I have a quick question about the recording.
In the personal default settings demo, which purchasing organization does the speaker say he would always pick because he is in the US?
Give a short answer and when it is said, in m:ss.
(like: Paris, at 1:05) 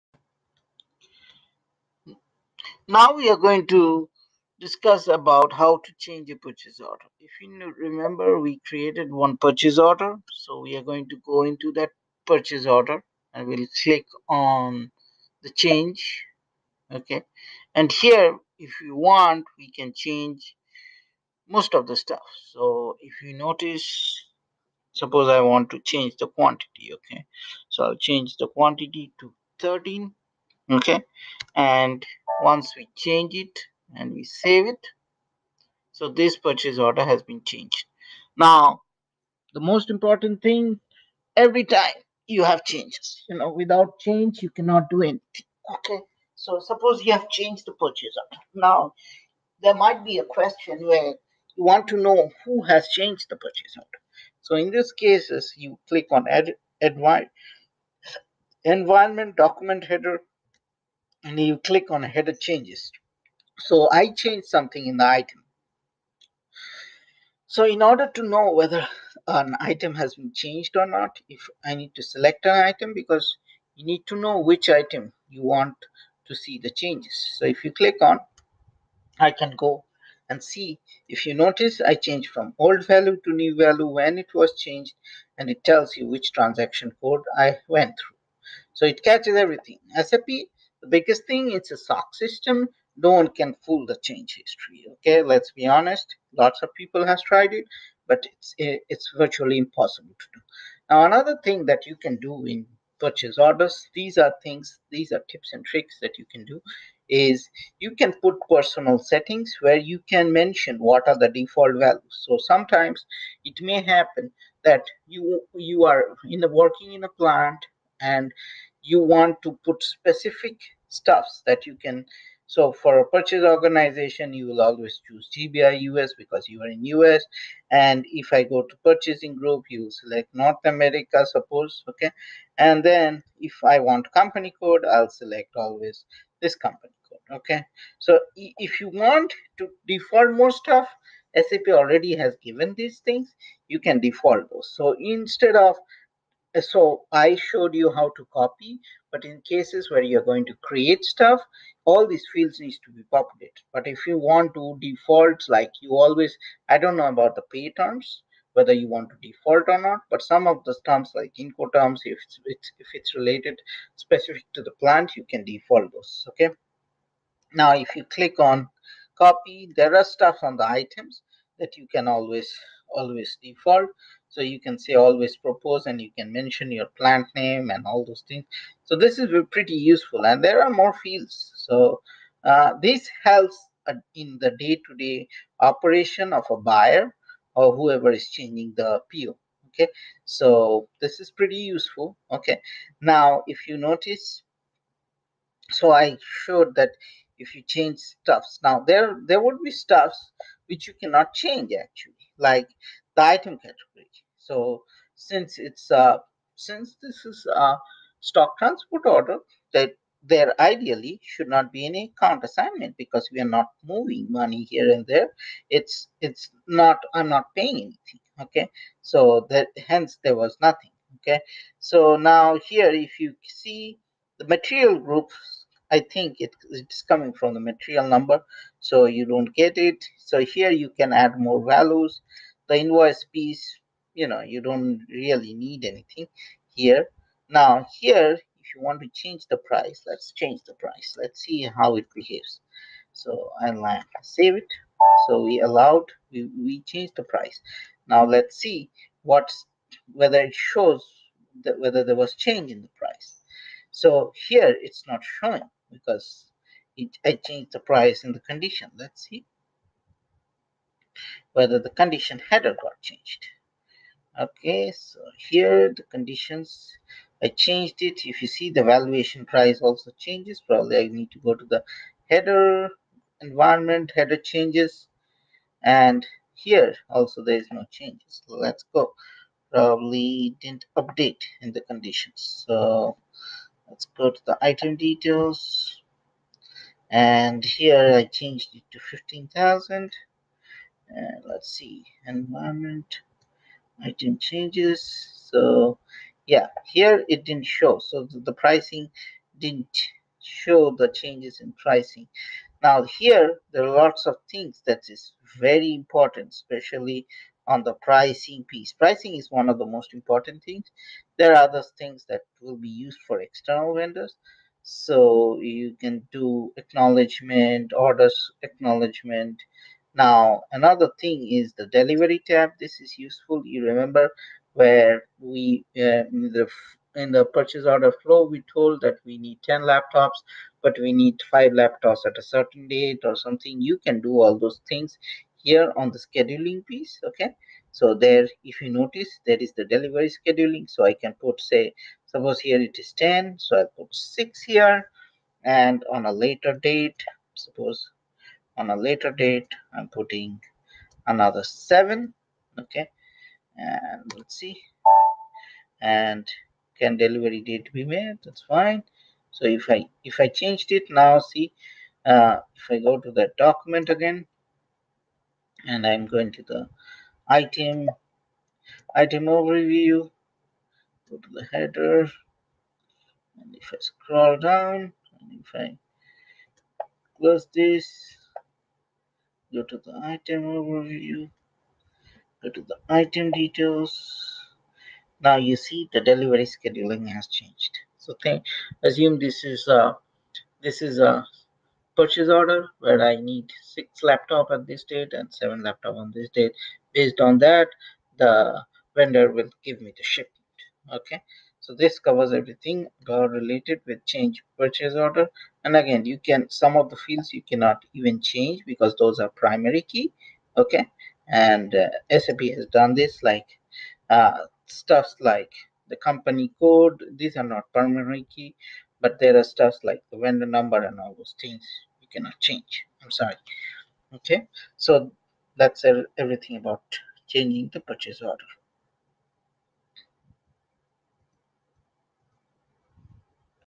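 GBI US, at 2:05.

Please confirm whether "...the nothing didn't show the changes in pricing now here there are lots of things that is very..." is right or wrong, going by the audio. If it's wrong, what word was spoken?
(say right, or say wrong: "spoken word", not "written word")
wrong: "pricing", not "nothing".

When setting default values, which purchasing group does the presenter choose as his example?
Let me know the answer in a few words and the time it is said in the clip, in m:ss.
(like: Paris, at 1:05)
North America, at 2:10.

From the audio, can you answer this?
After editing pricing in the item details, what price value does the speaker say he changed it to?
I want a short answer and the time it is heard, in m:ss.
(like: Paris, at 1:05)
15000, at 4:48.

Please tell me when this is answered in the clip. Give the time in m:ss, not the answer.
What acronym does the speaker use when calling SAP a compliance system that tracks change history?
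1:31.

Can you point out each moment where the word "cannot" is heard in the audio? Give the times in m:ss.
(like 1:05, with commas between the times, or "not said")
0:44, 3:21, 6:47, 7:02.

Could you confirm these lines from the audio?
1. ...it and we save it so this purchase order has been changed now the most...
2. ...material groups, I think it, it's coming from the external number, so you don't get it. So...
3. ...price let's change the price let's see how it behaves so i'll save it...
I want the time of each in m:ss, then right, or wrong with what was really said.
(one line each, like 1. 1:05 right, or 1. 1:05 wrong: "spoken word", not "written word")
1. 0:33 right
2. 3:44 wrong: "material", not "external"
3. 3:59 right.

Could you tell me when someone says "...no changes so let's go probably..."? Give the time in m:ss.
4:37.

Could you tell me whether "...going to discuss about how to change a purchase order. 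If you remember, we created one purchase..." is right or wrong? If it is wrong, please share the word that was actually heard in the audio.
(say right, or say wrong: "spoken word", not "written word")
right.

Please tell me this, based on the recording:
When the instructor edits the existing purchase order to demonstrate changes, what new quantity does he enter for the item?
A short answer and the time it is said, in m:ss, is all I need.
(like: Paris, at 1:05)
13, at 0:29.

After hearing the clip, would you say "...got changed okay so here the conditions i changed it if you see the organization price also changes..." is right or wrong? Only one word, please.
wrong.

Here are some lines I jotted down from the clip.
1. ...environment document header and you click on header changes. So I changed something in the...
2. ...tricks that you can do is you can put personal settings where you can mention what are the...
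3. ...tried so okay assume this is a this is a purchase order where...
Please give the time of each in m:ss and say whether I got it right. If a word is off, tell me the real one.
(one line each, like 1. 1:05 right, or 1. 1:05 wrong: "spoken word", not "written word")
1. 0:58 right
2. 1:45 right
3. 6:27 wrong: "changed", not "tried".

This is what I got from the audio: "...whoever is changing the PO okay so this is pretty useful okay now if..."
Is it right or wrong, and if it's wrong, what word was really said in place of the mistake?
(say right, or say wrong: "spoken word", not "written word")
right.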